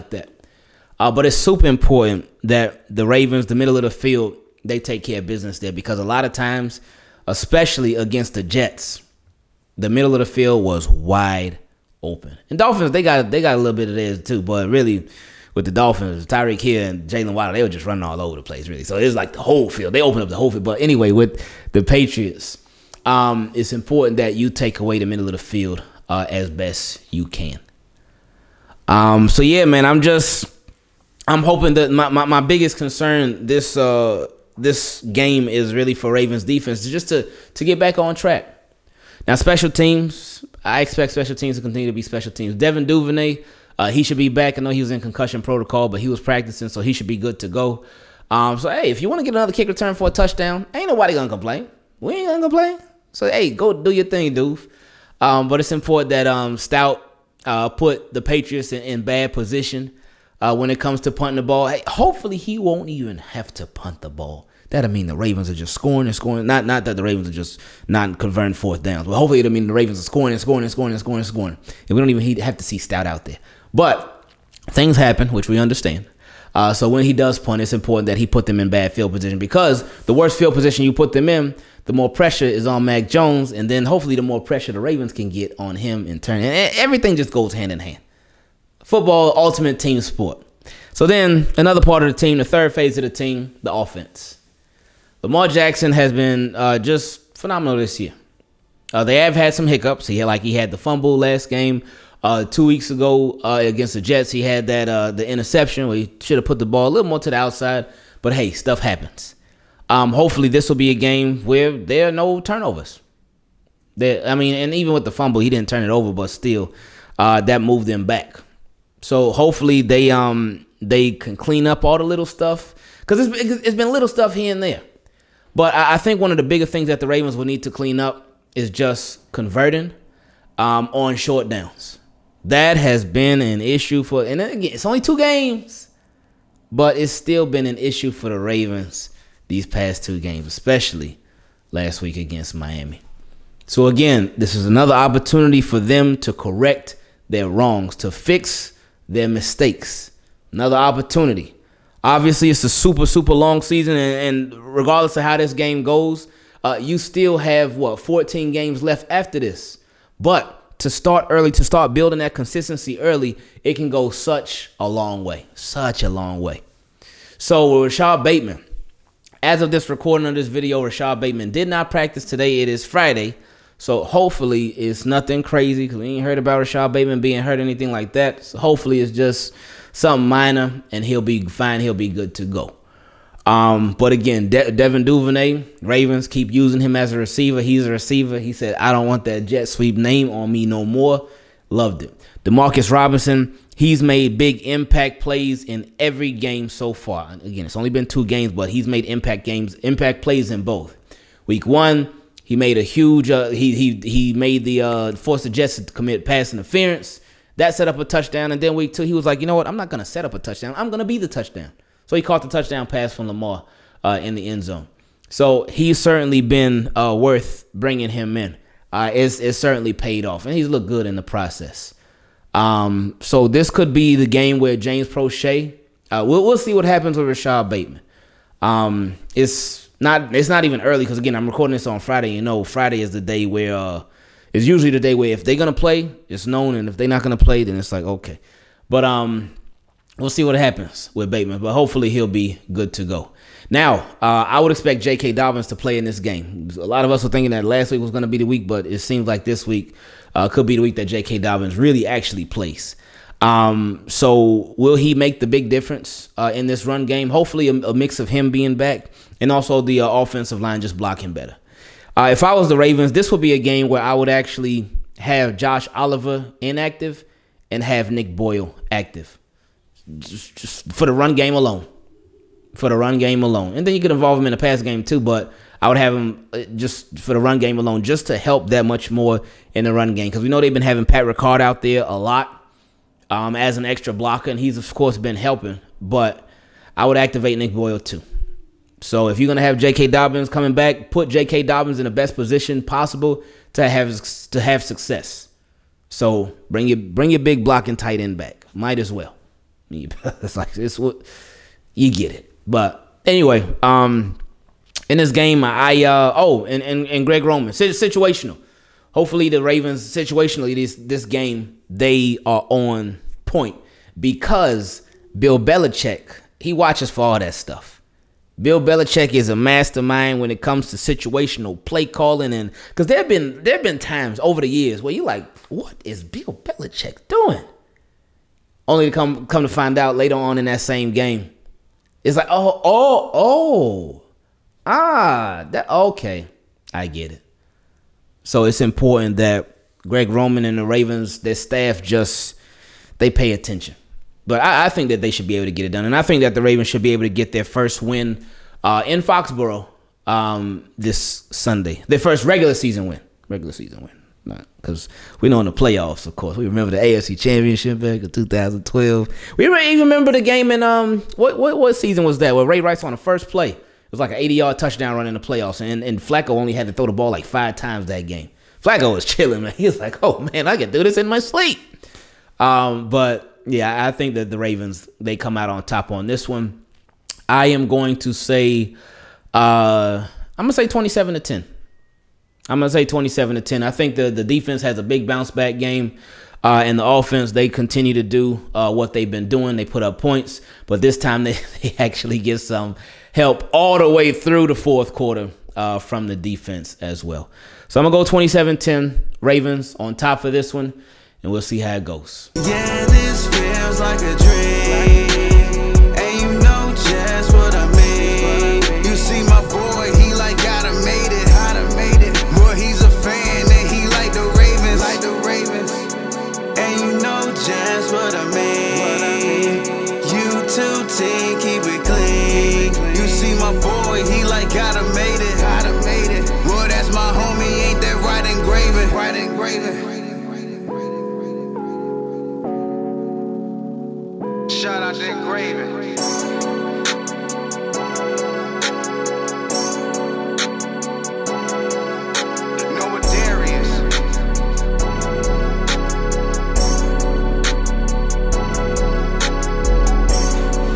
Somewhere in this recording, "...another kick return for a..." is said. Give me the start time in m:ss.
0:49.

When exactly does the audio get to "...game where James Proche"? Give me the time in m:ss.
3:44.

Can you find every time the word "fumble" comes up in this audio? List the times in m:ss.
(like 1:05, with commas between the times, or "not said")
1:40, 1:55.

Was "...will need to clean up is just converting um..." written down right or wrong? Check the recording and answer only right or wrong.
right.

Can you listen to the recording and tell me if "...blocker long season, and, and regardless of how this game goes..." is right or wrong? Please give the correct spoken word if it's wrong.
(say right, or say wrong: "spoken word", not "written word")
wrong: "super", not "blocker".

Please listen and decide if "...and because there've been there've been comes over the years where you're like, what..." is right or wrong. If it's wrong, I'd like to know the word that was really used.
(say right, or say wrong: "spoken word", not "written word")
wrong: "times", not "comes".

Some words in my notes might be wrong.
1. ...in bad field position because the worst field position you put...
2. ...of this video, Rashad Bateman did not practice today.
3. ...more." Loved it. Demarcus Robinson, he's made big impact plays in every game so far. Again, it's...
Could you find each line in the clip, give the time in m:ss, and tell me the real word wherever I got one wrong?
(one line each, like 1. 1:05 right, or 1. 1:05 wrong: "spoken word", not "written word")
1. 1:18 right
2. 2:50 right
3. 3:10 right.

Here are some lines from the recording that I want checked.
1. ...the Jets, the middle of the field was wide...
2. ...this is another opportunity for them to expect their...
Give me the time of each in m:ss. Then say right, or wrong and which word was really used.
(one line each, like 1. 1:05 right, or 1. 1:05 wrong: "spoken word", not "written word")
1. 0:08 right
2. 2:24 wrong: "correct", not "expect".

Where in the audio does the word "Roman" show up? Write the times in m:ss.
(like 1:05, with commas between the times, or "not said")
5:07, 5:40.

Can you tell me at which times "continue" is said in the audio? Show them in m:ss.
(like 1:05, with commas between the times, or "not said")
0:41, 6:27.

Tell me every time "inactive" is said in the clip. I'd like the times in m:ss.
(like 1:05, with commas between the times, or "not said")
4:26.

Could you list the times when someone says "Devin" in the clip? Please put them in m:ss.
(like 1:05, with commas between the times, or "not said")
0:42, 3:04.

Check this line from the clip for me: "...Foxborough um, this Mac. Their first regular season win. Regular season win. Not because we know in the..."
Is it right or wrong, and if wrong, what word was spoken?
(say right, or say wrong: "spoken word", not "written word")
wrong: "Sunday", not "Mac".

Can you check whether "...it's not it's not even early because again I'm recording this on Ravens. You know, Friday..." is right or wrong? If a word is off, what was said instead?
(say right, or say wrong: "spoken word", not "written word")
wrong: "Friday", not "Ravens".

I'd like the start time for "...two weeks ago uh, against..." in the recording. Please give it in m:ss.
1:42.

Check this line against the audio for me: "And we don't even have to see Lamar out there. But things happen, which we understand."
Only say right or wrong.
wrong.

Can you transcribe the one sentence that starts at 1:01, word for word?
Hey, hopefully, he won't even have to punt the ball.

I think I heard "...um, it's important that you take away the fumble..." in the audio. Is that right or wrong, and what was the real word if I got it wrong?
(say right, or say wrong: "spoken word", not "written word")
wrong: "middle", not "fumble".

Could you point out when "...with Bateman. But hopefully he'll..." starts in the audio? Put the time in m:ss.
4:01.